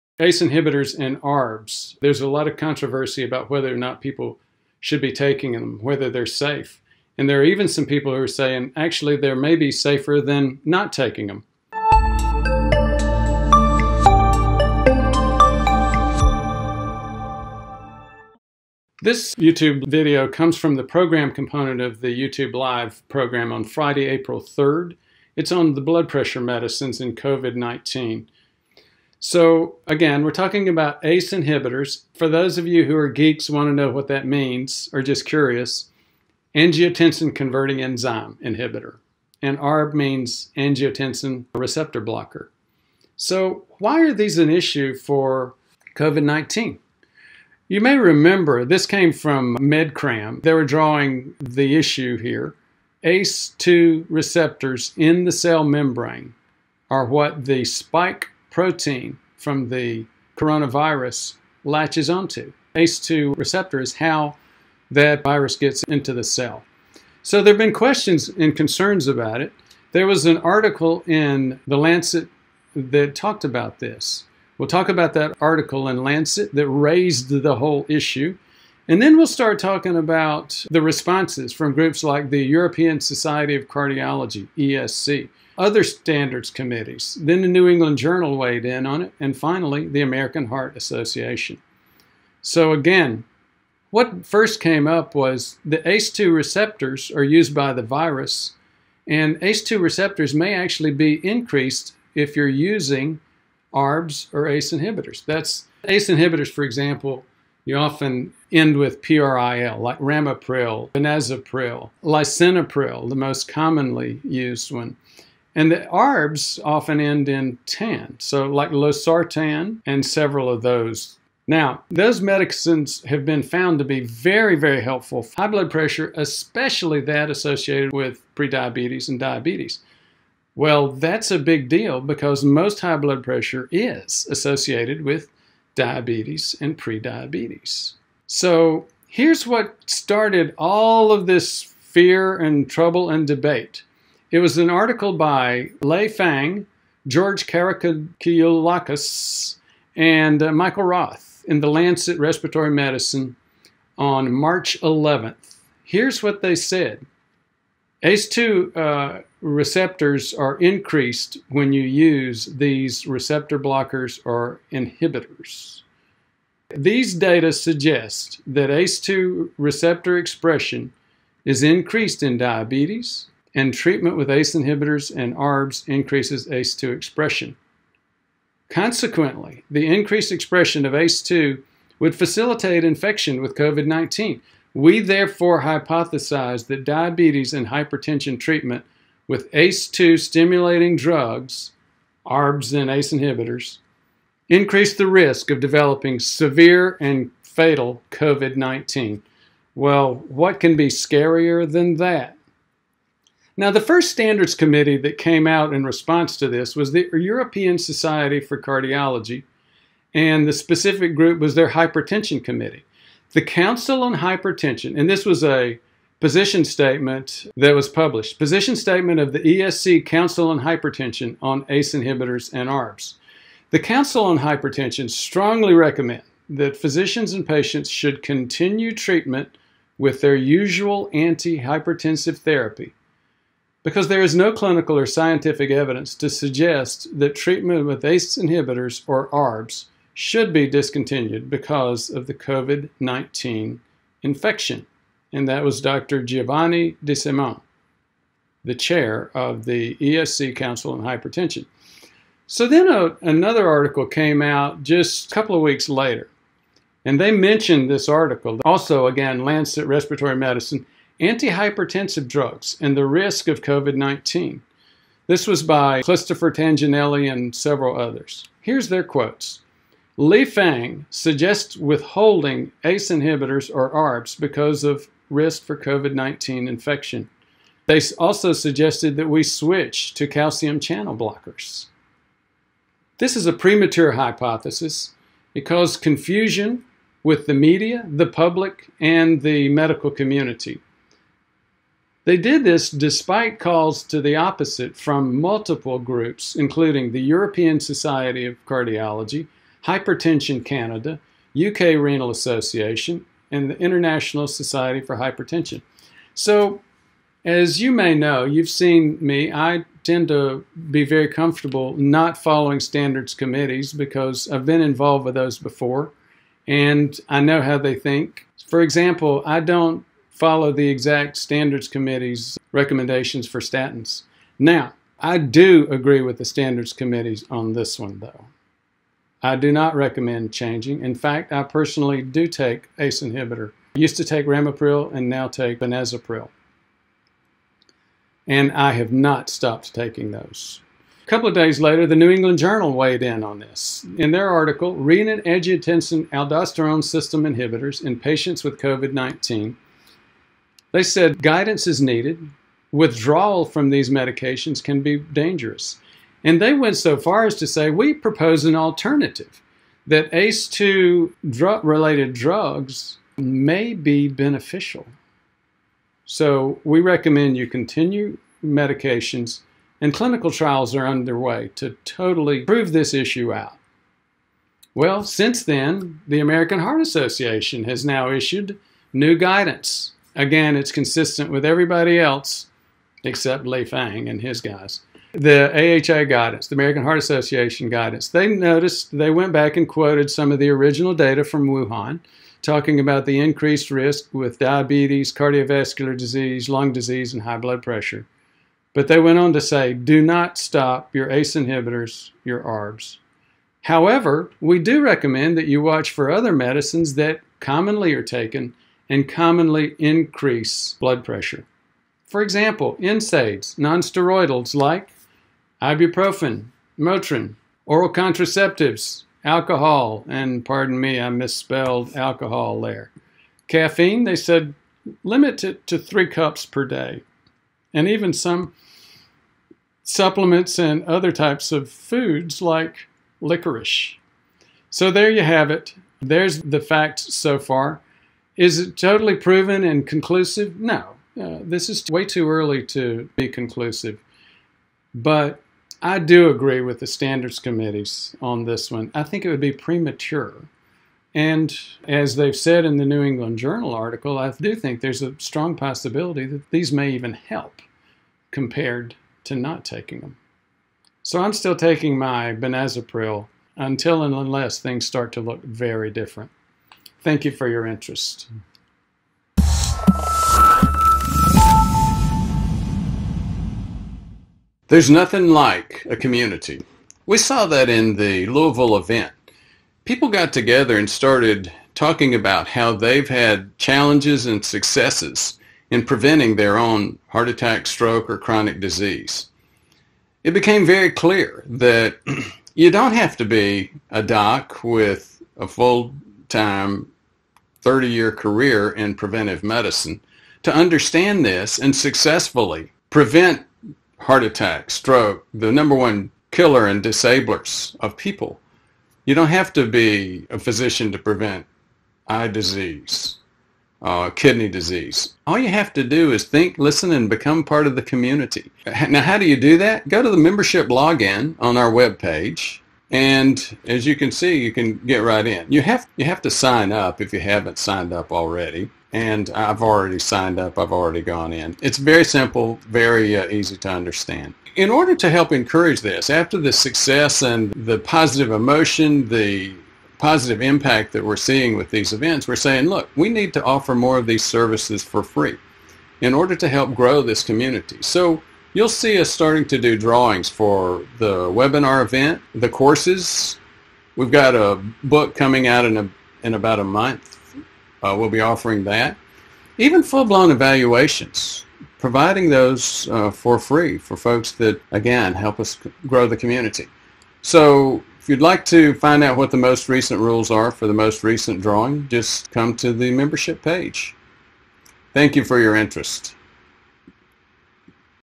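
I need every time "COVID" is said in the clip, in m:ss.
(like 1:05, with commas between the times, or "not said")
0:27, 0:45, 3:03, 3:18, 4:02, 4:23, 4:35, 5:48.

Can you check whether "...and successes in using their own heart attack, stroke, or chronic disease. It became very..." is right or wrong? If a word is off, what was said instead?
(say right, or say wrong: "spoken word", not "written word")
wrong: "preventing", not "using".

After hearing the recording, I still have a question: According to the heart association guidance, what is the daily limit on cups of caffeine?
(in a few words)
3 cups.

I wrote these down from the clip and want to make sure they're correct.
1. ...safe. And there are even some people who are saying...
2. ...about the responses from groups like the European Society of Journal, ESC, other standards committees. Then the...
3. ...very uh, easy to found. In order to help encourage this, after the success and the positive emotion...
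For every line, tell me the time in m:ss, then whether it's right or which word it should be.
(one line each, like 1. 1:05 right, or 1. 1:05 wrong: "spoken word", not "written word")
1. 0:06 right
2. 1:19 wrong: "Cardiology", not "Journal"
3. 8:52 wrong: "understand", not "found".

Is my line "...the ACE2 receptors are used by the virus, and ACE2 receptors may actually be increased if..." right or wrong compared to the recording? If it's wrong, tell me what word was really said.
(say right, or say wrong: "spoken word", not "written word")
right.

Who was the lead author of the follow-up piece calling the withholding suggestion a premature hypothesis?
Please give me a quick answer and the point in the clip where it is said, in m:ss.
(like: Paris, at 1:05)
Christopher Tignanelli, at 4:26.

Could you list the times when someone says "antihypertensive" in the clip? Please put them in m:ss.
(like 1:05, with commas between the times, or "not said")
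3:51, 4:21.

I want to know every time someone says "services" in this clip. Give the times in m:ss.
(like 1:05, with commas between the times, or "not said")
9:04.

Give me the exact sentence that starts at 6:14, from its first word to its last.
Well, since then, the American Heart Association has now issued new guidance.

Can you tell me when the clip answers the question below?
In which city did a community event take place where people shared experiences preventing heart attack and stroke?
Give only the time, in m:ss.
7:58.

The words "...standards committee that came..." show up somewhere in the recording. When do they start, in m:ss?
3:24.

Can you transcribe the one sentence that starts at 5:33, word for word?
I used to take ramipril and now take benazepril.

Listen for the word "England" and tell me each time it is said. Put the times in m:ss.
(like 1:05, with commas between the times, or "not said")
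1:27, 5:42, 7:33.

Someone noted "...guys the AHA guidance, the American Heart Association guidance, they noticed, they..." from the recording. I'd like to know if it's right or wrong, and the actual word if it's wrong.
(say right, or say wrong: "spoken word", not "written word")
right.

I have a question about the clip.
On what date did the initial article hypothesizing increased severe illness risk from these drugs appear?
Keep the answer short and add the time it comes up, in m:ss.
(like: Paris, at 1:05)
March 11th, at 2:34.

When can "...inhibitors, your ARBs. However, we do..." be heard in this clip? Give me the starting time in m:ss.
6:41.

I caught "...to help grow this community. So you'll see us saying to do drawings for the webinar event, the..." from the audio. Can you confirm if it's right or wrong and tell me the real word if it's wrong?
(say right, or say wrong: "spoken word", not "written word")
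wrong: "starting", not "saying".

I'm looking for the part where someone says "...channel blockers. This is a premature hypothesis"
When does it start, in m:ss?
4:40.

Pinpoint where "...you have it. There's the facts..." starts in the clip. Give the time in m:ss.
7:15.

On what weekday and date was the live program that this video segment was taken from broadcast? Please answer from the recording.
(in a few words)
Friday, April 3rd.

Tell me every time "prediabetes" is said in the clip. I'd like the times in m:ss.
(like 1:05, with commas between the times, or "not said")
2:08, 2:16.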